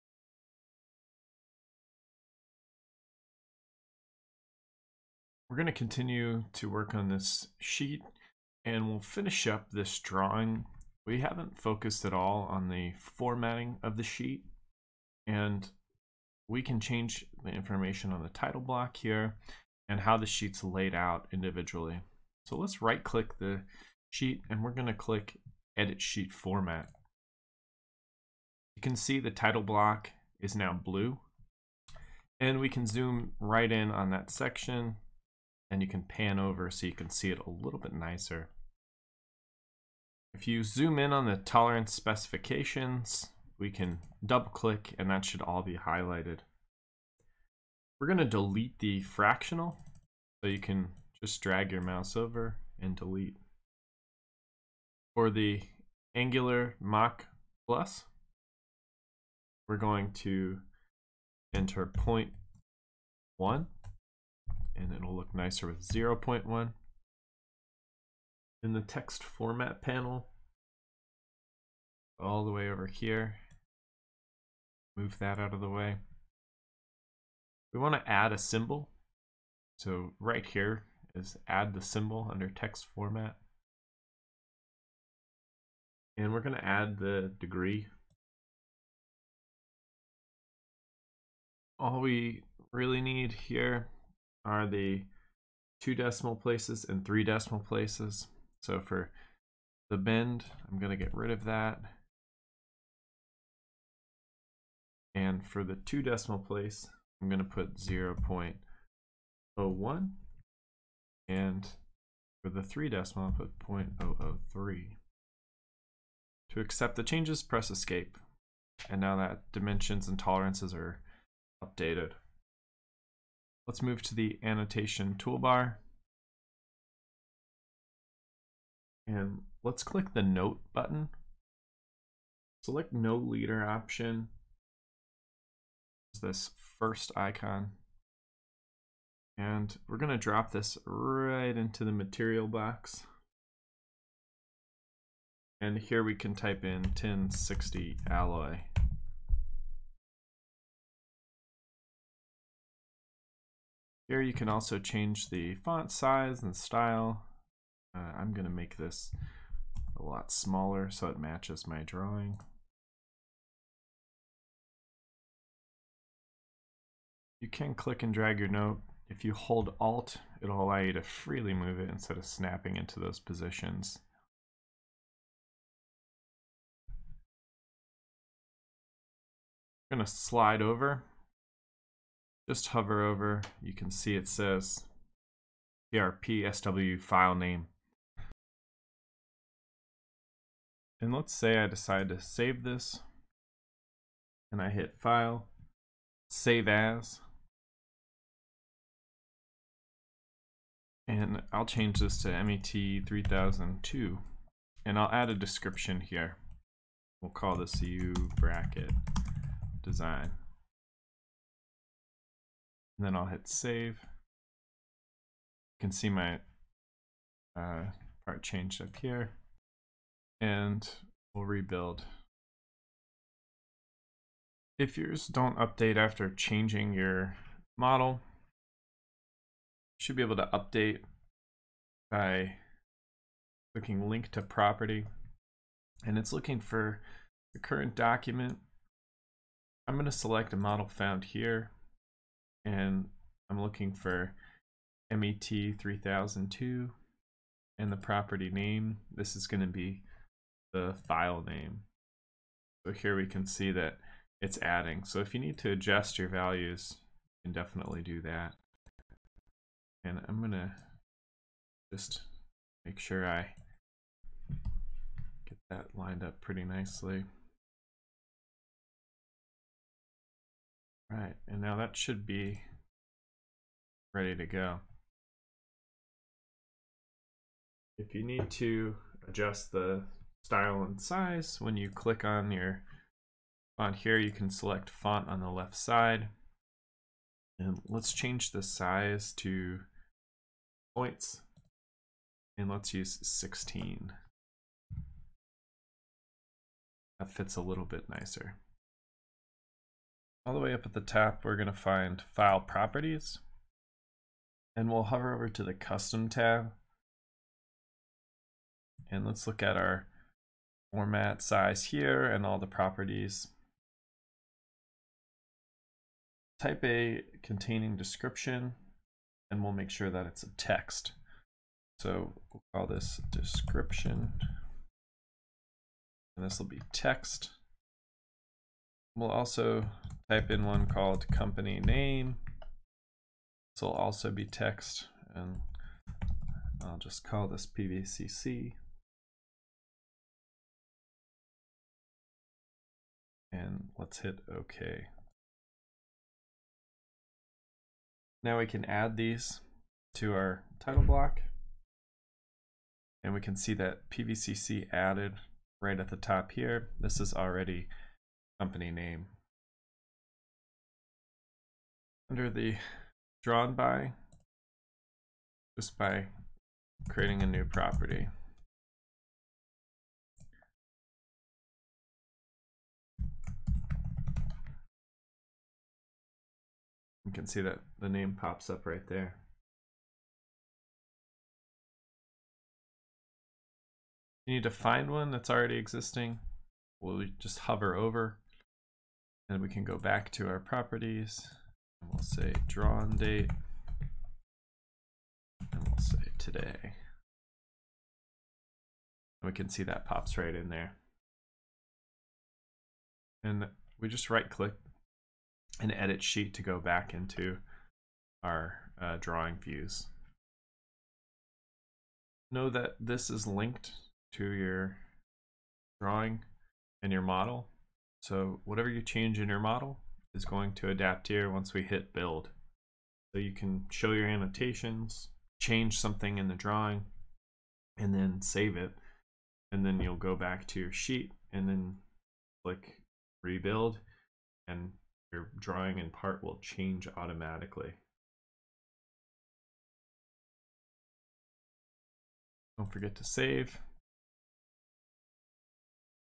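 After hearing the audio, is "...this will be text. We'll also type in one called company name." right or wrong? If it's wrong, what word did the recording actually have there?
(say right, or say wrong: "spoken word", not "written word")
right.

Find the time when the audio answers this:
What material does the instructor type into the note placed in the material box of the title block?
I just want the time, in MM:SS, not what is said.
02:26.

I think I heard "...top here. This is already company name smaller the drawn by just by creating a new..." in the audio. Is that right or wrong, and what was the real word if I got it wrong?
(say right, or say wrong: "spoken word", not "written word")
wrong: "under", not "smaller".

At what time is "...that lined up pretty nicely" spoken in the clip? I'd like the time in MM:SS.
04:25.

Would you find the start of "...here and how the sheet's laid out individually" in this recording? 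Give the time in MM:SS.
00:18.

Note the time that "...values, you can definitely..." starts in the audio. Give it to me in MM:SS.
04:16.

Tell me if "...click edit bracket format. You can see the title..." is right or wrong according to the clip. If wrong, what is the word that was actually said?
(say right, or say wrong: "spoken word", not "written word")
wrong: "sheet", not "bracket".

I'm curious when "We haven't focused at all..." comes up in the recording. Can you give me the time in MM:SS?
00:11.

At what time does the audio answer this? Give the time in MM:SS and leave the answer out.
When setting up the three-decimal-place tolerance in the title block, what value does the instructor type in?
01:53.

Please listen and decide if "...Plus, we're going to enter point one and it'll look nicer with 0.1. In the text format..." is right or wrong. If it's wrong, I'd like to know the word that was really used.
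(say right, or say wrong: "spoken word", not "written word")
right.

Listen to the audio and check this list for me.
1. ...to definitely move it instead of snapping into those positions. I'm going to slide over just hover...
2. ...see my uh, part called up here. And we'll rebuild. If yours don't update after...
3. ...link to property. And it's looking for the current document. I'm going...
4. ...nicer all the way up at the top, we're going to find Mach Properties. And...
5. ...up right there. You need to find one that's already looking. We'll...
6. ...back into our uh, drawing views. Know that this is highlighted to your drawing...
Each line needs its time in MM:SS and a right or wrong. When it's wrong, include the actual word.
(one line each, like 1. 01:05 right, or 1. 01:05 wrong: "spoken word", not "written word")
1. 02:50 wrong: "freely", not "definitely"
2. 03:35 wrong: "changed", not "called"
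3. 03:54 right
4. 04:58 wrong: "File", not "Mach"
5. 06:18 wrong: "existing", not "looking"
6. 06:46 wrong: "linked", not "highlighted".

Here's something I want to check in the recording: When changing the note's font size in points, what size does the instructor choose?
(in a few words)
16.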